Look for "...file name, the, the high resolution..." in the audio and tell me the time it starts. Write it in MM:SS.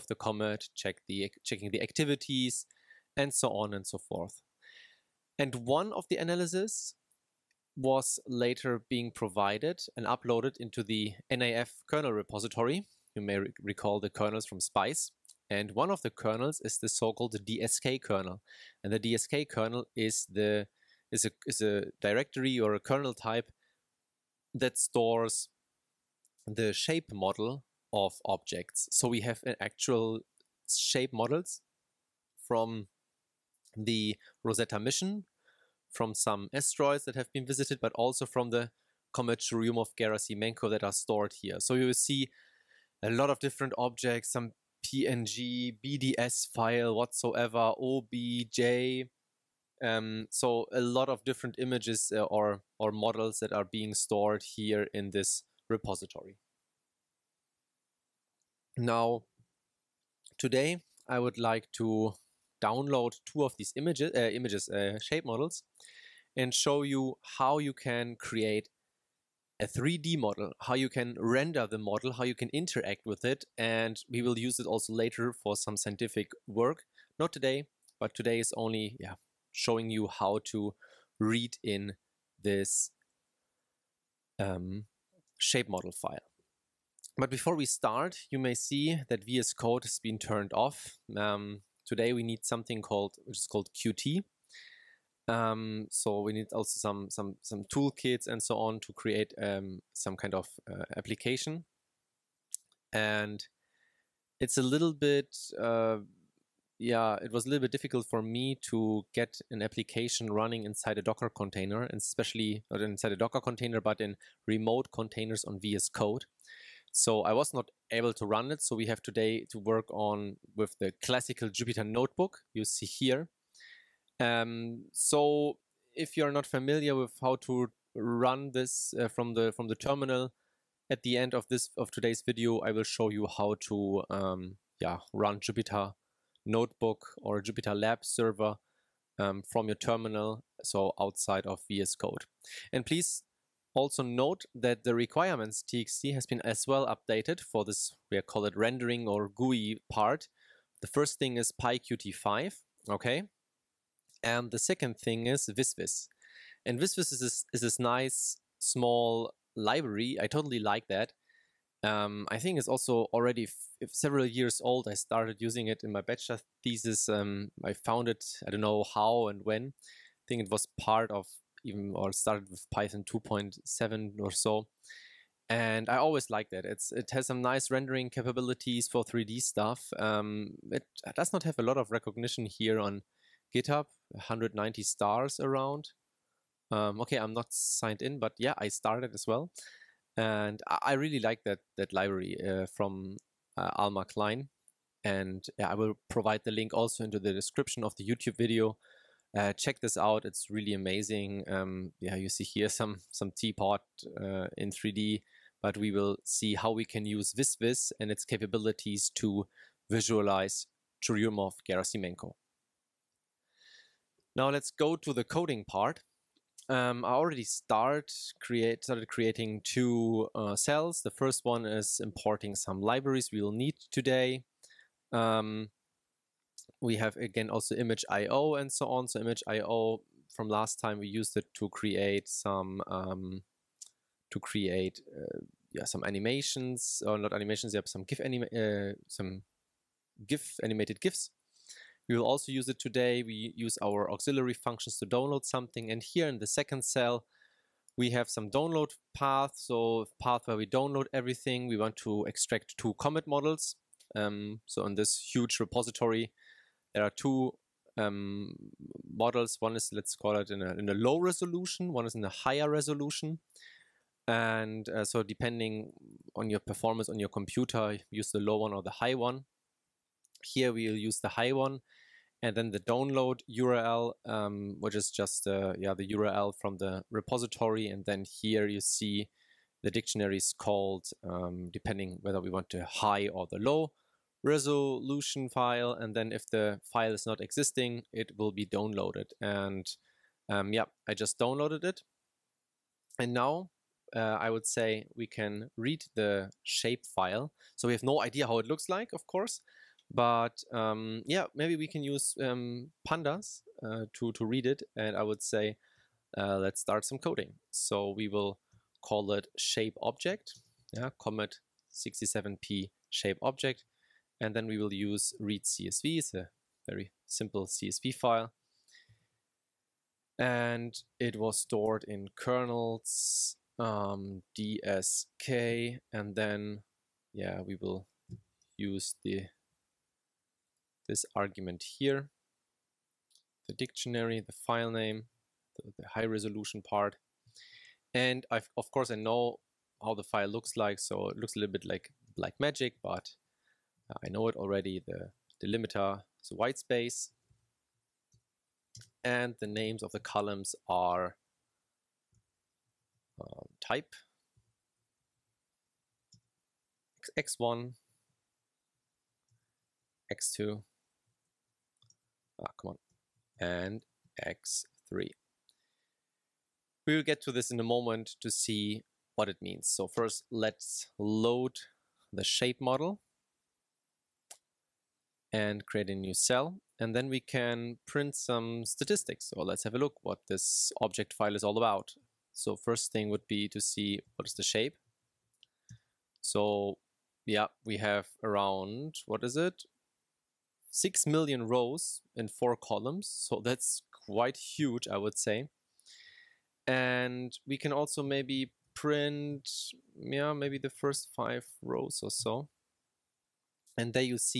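05:34.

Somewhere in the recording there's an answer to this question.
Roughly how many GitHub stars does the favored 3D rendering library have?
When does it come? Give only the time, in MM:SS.
03:04.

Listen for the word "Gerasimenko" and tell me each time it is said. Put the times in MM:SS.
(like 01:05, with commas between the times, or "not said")
00:39, 03:31.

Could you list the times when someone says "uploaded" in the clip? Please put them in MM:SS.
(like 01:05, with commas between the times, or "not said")
00:10.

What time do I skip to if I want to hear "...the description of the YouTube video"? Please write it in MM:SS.
03:17.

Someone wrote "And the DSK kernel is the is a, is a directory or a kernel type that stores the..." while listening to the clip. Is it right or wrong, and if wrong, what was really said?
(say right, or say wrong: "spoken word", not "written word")
right.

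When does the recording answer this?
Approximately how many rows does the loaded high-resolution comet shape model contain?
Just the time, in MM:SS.
06:30.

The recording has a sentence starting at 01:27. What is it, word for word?
But before we start, you may see that VS Code has been turned off.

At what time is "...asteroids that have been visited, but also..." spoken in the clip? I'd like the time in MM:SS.
00:36.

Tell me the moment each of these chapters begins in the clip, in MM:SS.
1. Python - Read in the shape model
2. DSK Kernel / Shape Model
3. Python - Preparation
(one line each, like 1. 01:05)
1. 05:01
2. 00:06
3. 03:33.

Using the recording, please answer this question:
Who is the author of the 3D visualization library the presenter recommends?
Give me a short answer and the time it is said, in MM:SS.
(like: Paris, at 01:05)
Almar Klein, at 03:13.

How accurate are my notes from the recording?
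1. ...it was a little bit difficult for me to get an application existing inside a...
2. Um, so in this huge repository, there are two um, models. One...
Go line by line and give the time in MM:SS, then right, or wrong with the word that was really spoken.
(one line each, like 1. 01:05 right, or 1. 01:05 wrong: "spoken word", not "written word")
1. 01:47 wrong: "running", not "existing"
2. 04:14 right.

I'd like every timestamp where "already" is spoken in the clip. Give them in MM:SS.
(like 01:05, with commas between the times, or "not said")
02:43, 03:37, 05:44.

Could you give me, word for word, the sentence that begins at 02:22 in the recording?
And please also note that the requirements txt has been as well updated for this, we call it rendering or GUI part.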